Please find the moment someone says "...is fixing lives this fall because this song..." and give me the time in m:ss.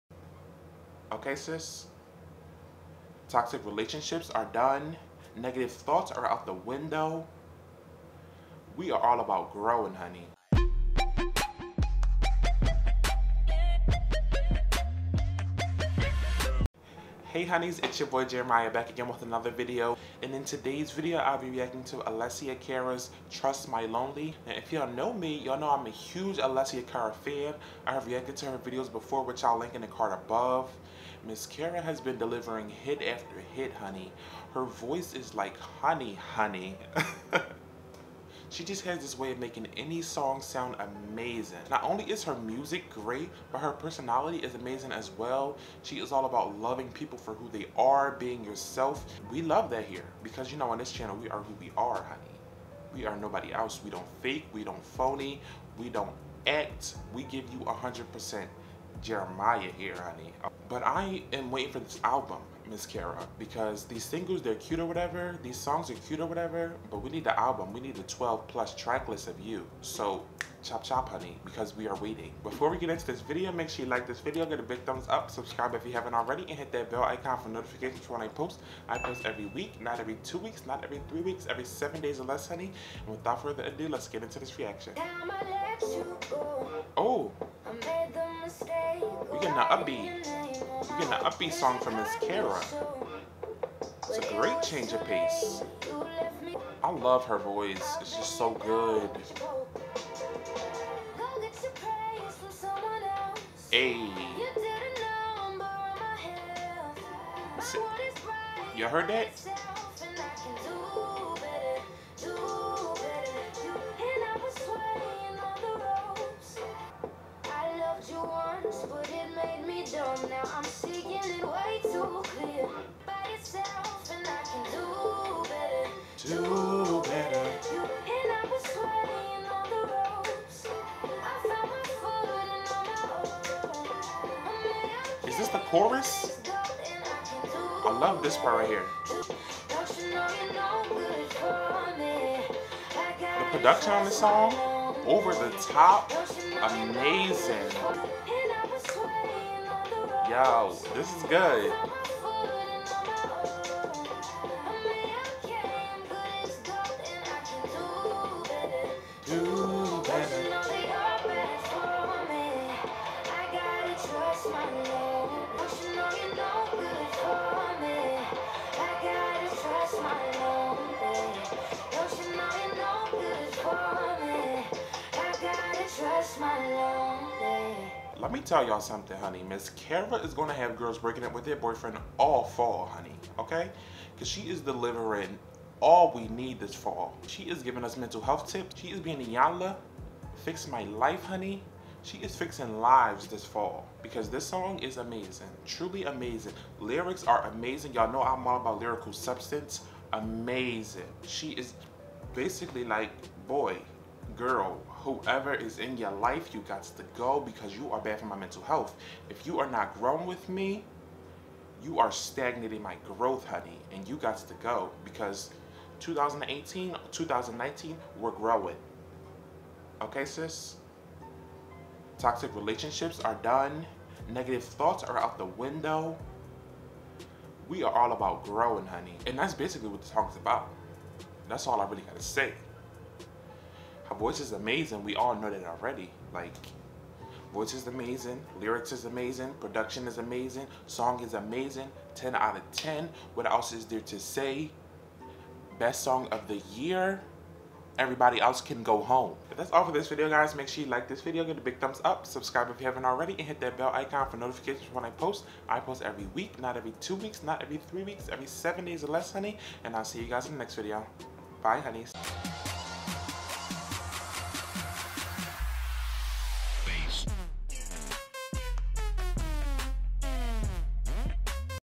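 3:12.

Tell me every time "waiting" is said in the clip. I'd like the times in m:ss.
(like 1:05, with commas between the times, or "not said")
1:01, 1:11.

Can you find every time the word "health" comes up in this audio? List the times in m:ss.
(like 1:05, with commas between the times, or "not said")
3:08, 3:28.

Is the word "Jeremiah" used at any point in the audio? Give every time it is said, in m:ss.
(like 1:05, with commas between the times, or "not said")
0:18, 0:59.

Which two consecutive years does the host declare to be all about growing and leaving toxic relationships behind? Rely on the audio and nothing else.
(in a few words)
2018, 2019.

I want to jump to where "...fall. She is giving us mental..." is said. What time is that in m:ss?
3:06.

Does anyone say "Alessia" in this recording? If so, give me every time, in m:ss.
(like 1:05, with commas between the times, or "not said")
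0:21, 0:26.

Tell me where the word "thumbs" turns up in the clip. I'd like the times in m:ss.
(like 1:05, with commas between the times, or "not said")
1:14, 4:11.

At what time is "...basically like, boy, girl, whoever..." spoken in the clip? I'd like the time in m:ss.
3:22.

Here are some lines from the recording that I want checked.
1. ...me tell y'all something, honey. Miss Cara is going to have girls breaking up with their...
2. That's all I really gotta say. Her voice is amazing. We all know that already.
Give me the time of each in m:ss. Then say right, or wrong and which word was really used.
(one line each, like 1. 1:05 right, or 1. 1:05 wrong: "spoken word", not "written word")
1. 2:58 right
2. 3:51 right.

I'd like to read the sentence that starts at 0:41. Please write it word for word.
Not only is her music great, but her personality is amazing as well.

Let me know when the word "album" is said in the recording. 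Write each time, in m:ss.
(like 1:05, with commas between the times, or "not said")
1:02, 1:07.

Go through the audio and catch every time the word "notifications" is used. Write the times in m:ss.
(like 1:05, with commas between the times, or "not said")
1:17, 4:14.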